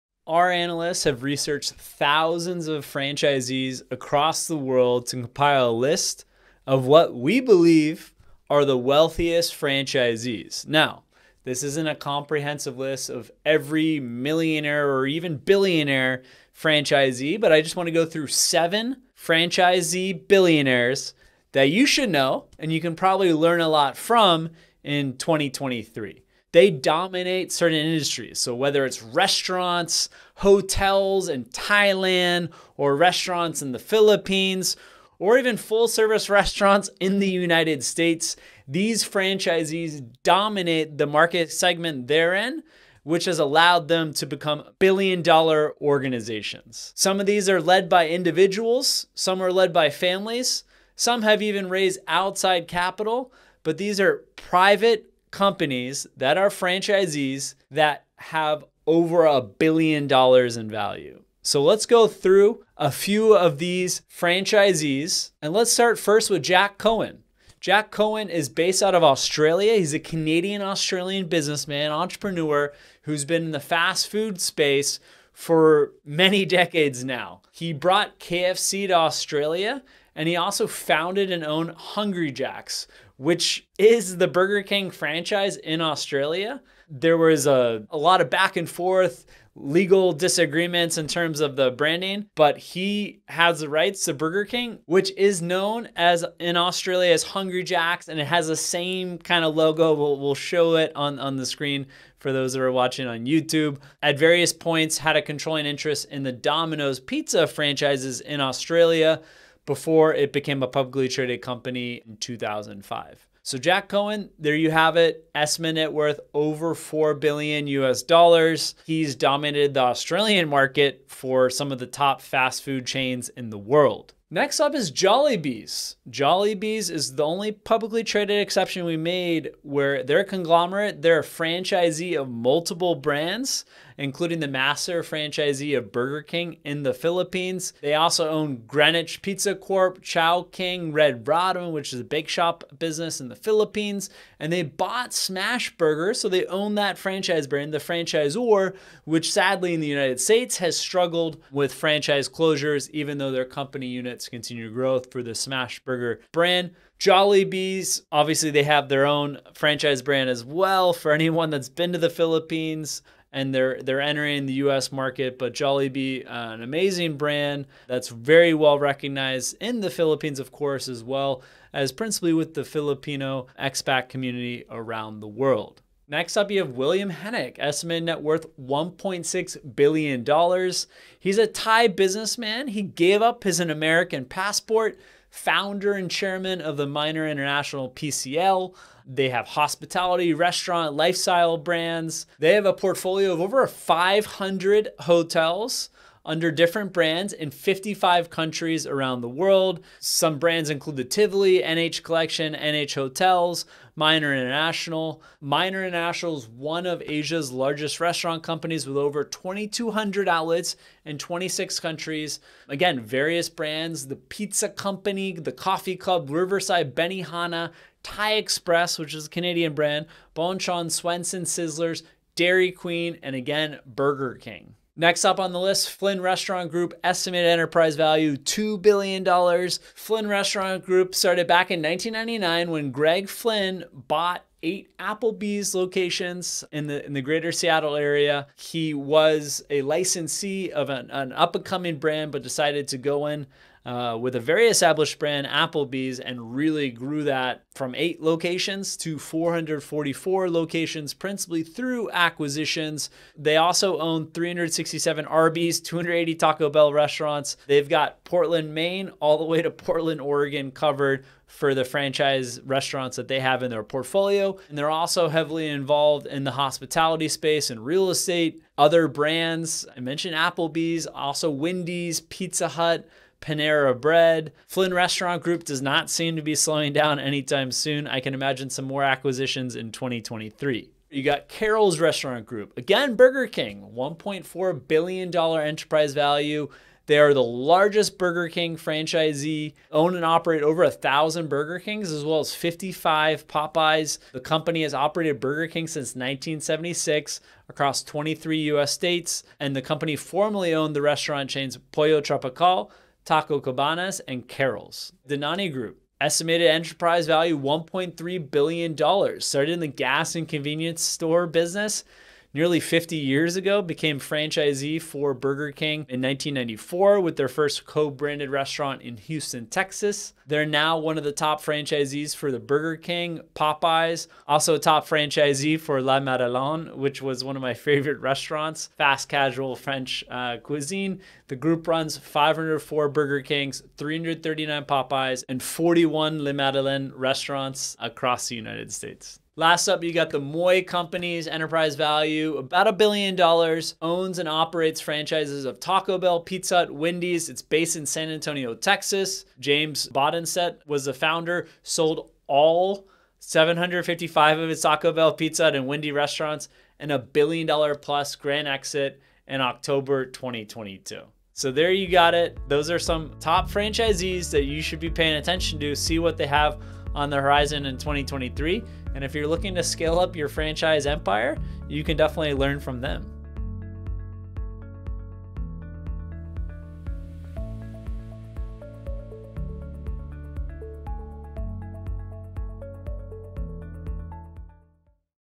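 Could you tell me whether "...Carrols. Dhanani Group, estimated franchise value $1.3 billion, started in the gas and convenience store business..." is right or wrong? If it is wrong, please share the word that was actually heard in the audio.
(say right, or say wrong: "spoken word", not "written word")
wrong: "enterprise", not "franchise".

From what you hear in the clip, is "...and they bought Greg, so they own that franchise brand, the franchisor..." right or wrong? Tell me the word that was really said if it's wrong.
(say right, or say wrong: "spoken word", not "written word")
wrong: "Smashburger", not "Greg".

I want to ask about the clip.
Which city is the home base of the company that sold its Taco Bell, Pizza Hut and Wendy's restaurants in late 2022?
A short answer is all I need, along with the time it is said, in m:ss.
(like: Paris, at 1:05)
San Antonio, at 5:48.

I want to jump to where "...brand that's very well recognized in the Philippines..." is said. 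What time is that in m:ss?
2:47.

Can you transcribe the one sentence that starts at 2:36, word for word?
Jollibees, obviously, they have their own franchise brand as well.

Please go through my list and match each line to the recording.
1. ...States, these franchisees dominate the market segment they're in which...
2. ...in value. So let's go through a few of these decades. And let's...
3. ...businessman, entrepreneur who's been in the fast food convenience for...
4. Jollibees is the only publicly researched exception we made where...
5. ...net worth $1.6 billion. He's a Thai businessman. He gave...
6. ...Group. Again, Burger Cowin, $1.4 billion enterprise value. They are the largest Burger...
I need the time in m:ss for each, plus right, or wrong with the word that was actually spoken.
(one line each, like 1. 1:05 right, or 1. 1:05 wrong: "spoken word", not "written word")
1. 0:37 right
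2. 1:00 wrong: "franchisees", not "decades"
3. 1:11 wrong: "space", not "convenience"
4. 2:06 wrong: "traded", not "researched"
5. 2:58 right
6. 4:42 wrong: "King", not "Cowin".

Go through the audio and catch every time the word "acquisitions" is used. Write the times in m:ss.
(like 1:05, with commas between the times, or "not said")
4:12, 4:39.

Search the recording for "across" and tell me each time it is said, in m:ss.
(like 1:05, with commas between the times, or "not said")
0:03, 4:57, 5:37.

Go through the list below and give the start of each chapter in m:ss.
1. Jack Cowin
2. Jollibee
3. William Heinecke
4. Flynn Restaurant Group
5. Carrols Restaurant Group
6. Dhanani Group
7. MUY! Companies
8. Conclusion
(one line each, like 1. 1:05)
1. 1:04
2. 2:04
3. 2:55
4. 3:44
5. 4:40
6. 5:04
7. 5:40
8. 6:01.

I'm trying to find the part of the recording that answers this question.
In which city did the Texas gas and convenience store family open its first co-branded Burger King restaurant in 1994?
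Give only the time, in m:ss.
5:19.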